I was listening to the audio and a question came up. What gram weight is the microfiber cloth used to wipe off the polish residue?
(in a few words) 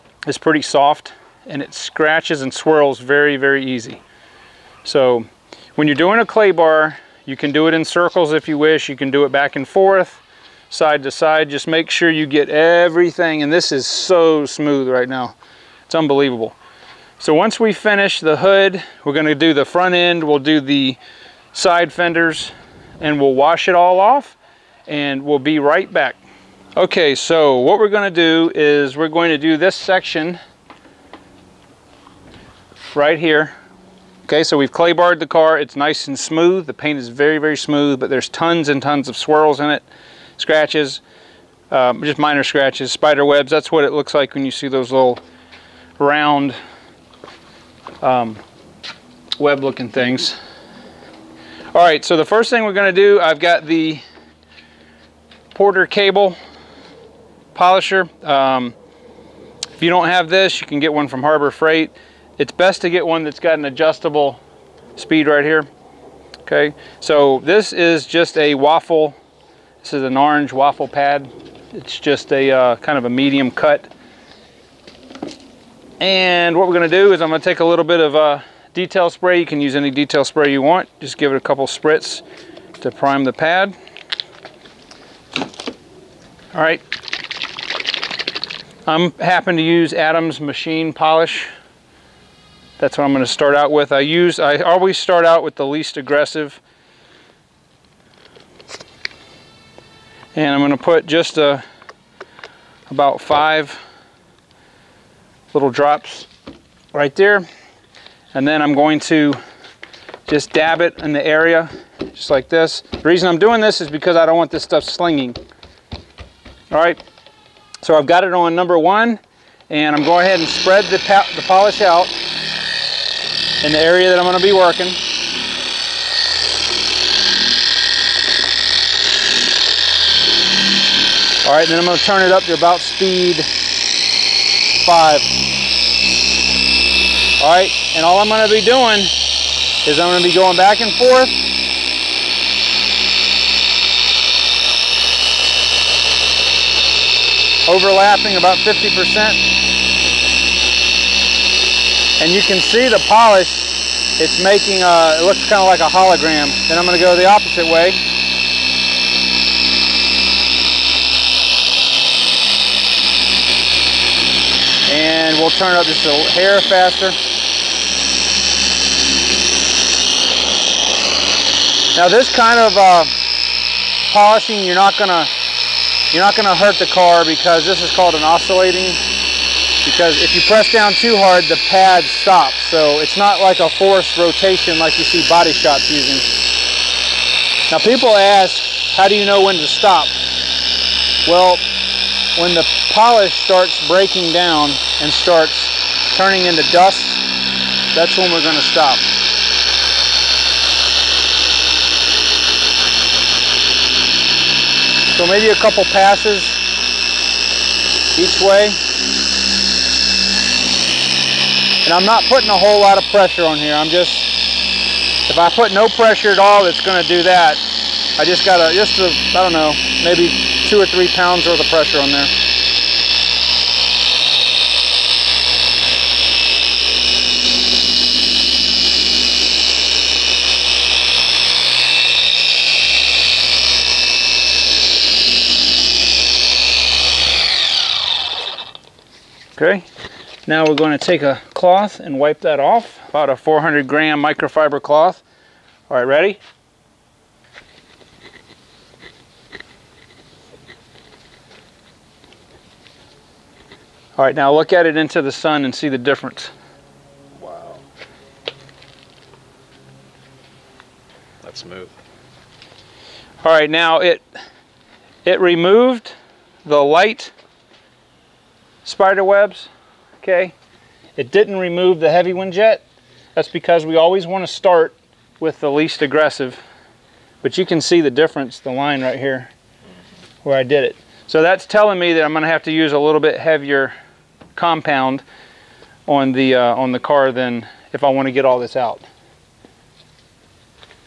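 400 gram.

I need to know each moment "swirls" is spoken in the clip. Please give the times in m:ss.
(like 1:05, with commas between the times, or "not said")
0:02, 0:39.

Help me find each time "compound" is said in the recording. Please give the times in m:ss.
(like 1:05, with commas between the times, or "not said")
4:44.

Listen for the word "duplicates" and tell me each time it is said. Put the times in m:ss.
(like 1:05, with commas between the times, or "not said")
not said.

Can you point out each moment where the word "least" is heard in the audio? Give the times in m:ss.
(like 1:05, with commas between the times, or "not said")
1:35, 4:35.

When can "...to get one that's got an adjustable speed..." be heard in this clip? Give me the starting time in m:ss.
1:02.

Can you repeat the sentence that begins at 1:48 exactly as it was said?
And then I'm going to just dab it in the area, just like this.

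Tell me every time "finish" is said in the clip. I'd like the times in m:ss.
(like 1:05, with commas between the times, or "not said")
0:17.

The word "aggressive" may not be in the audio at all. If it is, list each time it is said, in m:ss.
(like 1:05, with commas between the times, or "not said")
1:35, 4:36.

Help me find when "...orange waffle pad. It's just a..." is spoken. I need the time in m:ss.
1:10.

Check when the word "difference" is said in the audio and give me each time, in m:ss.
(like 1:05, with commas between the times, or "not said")
4:15, 4:38.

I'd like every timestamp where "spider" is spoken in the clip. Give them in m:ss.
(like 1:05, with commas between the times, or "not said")
0:42, 4:28.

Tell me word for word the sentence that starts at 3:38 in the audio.
I just got a, just a, I don't know, maybe two or three pounds worth of pressure on there.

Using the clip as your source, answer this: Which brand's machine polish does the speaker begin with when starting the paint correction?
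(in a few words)
Adam's.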